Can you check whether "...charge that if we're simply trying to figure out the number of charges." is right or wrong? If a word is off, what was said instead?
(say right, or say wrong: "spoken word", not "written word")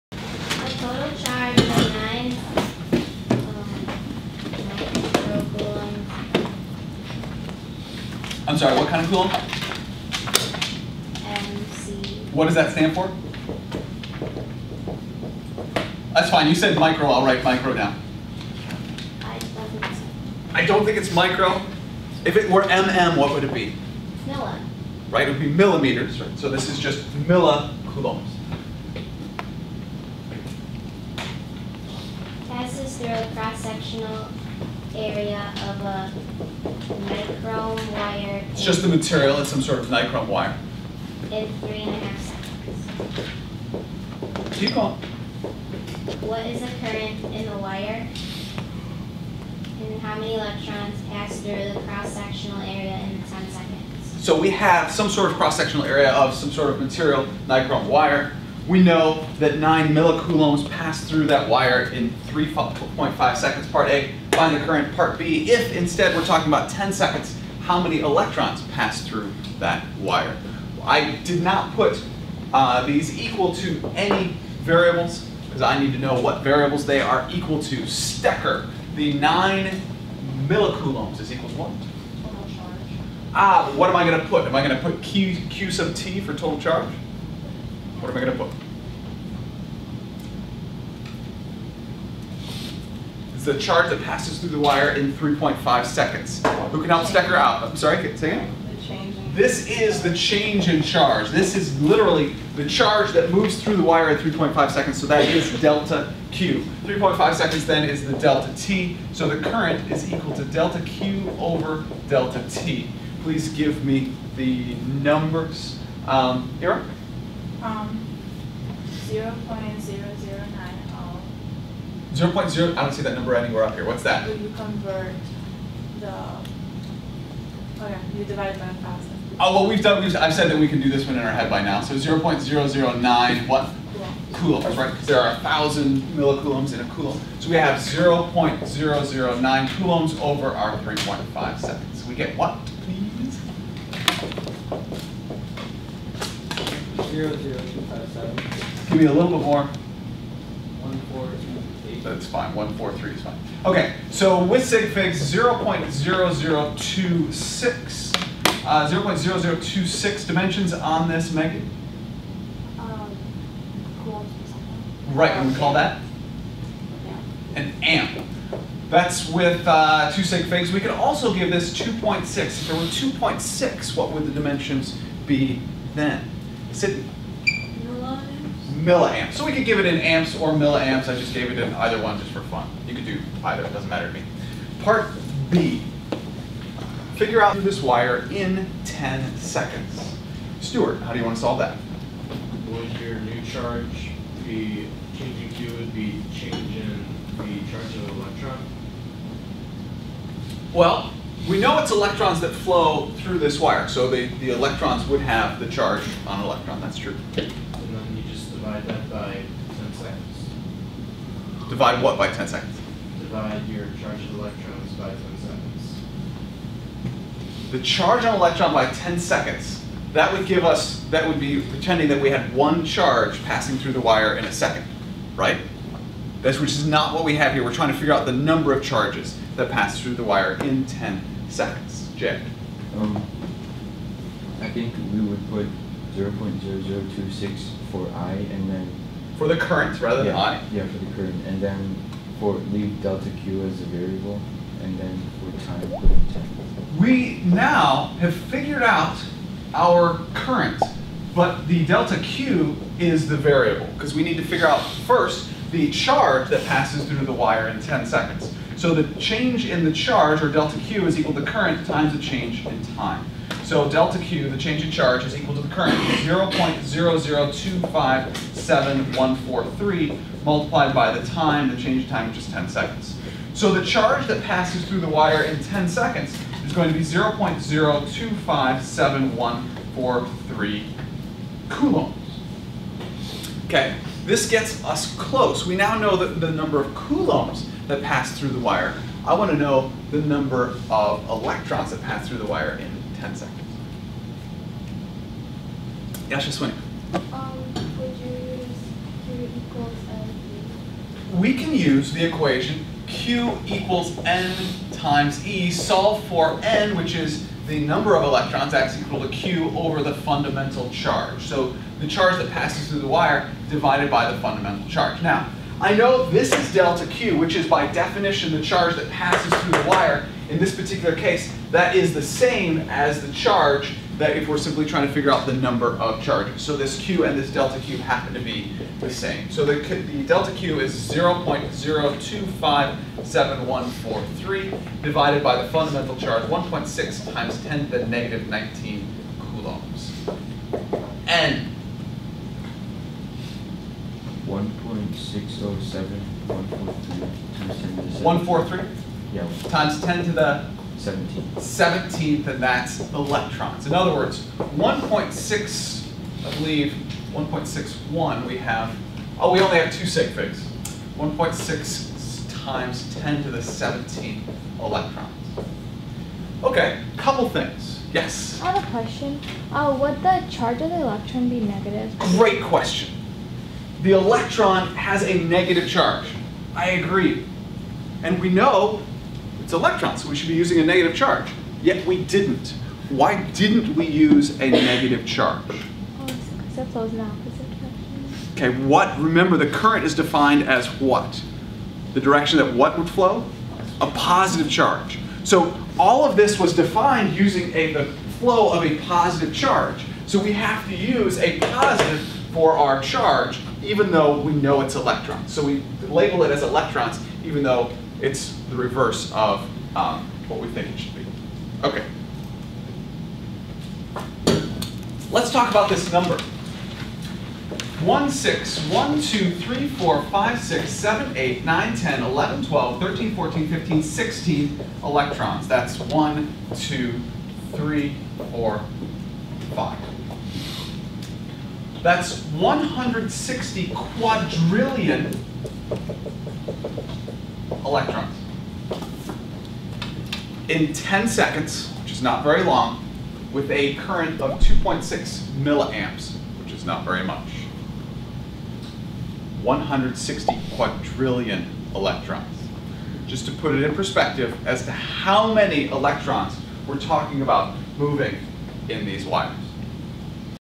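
right.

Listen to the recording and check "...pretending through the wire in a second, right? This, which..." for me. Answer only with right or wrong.
wrong.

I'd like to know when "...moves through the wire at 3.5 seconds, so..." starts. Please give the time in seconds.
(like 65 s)
103 s.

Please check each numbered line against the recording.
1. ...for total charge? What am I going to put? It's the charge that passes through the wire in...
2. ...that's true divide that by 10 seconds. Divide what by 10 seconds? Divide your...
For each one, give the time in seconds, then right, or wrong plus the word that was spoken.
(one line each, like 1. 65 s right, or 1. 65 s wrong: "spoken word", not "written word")
1. 86 s right
2. 206 s right.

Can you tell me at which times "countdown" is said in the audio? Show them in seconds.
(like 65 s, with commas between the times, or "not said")
not said.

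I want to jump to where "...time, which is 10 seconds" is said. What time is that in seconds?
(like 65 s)
272 s.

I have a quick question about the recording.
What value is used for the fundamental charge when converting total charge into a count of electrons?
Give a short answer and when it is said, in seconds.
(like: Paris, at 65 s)
1.6 x 10^-19 coulombs, at 336 s.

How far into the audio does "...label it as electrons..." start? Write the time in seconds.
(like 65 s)
406 s.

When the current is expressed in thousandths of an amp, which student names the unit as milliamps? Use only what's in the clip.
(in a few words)
Sydney.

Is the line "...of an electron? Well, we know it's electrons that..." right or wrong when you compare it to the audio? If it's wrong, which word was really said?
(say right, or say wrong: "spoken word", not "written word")
right.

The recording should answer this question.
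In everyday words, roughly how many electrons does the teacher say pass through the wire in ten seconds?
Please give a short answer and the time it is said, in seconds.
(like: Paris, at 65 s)
160 quadrillion, at 449 s.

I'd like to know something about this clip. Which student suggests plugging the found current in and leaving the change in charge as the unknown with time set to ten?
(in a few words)
Jake.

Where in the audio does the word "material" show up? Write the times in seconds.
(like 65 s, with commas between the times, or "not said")
38 s, 56 s.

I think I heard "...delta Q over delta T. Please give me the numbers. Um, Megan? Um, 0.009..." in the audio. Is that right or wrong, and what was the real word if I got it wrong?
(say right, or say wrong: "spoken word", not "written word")
wrong: "Ira", not "Megan".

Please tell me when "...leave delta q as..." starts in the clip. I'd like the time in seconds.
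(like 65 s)
242 s.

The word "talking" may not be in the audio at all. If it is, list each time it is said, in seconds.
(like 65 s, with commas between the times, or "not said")
66 s, 456 s.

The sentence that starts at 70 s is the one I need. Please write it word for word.
I did not put uh, these equal to any variables because I need to know what variables they are equal to.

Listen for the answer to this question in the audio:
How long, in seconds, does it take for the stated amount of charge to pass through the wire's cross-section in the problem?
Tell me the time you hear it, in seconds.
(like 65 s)
41 s.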